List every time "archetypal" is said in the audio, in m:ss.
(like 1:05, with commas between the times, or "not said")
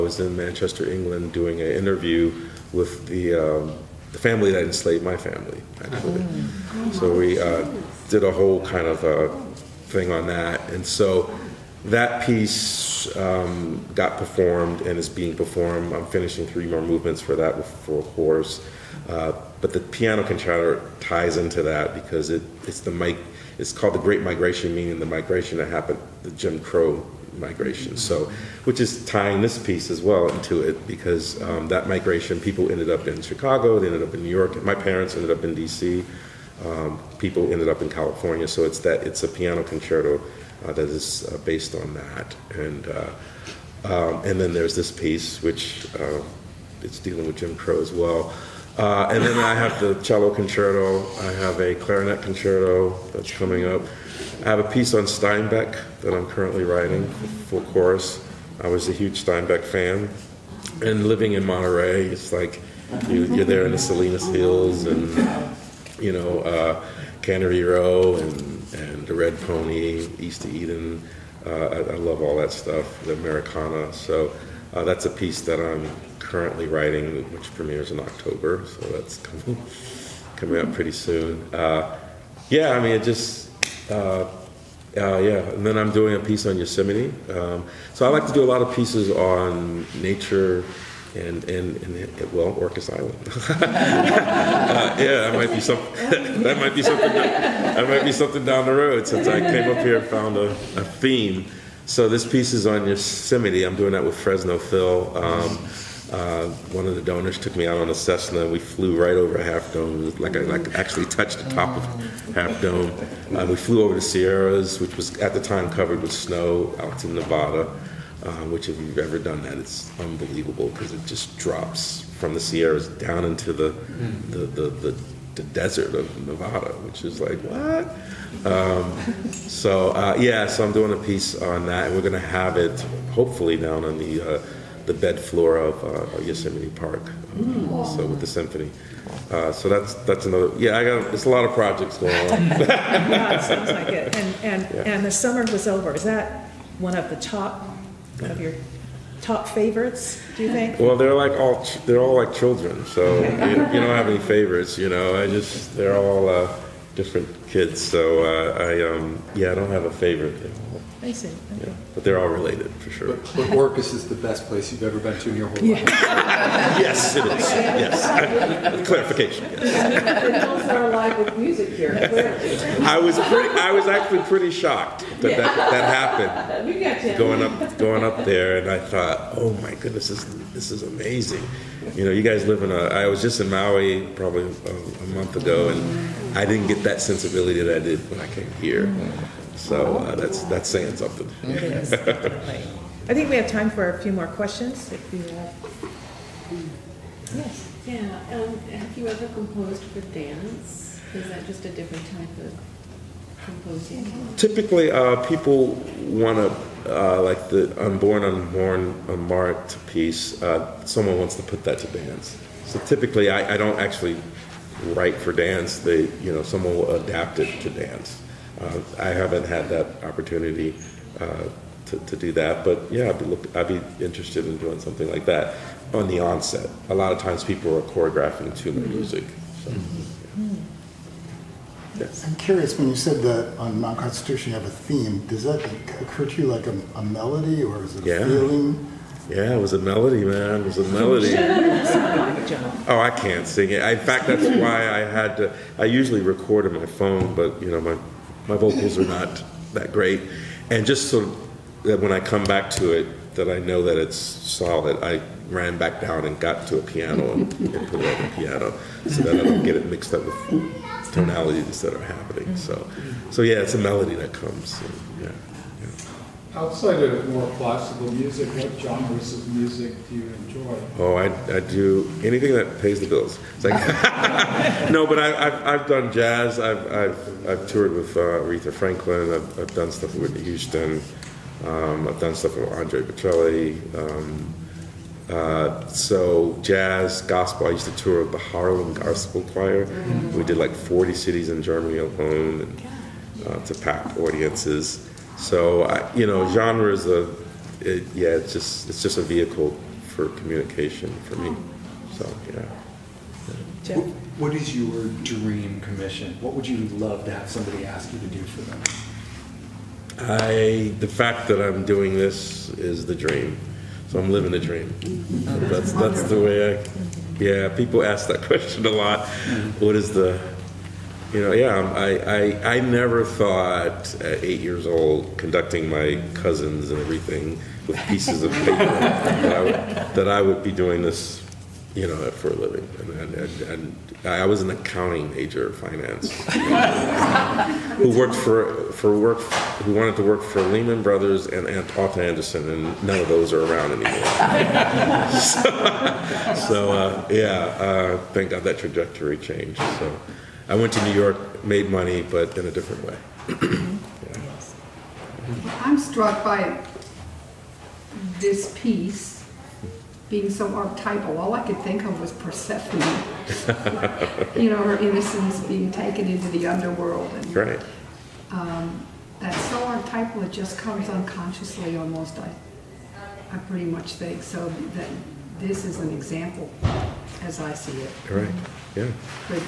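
6:00, 6:09.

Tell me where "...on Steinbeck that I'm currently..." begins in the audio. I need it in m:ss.
0:54.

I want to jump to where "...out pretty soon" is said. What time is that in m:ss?
1:20.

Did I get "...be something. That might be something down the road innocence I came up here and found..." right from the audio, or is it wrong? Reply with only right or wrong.
wrong.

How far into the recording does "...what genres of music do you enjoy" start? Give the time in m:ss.
4:28.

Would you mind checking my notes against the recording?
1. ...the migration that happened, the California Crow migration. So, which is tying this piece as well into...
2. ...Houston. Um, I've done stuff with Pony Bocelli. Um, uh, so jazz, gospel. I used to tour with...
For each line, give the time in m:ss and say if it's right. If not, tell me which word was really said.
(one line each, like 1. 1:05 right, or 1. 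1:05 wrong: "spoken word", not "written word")
1. 0:24 wrong: "Jim", not "California"
2. 4:40 wrong: "Andre", not "Pony".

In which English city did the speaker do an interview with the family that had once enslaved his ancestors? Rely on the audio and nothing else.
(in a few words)
Manchester.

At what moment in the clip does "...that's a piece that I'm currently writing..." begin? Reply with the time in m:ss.
1:14.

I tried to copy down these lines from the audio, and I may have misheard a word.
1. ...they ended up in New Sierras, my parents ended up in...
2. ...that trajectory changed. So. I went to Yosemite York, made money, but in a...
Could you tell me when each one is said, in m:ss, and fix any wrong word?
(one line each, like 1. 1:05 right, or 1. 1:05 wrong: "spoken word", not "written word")
1. 0:33 wrong: "York", not "Sierras"
2. 5:48 wrong: "New", not "Yosemite".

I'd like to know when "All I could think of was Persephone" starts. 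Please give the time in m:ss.
6:01.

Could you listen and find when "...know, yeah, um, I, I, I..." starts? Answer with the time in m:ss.
5:21.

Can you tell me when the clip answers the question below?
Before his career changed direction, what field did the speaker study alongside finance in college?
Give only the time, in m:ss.
5:34.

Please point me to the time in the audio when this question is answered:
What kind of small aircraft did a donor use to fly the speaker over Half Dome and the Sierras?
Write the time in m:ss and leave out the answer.
1:47.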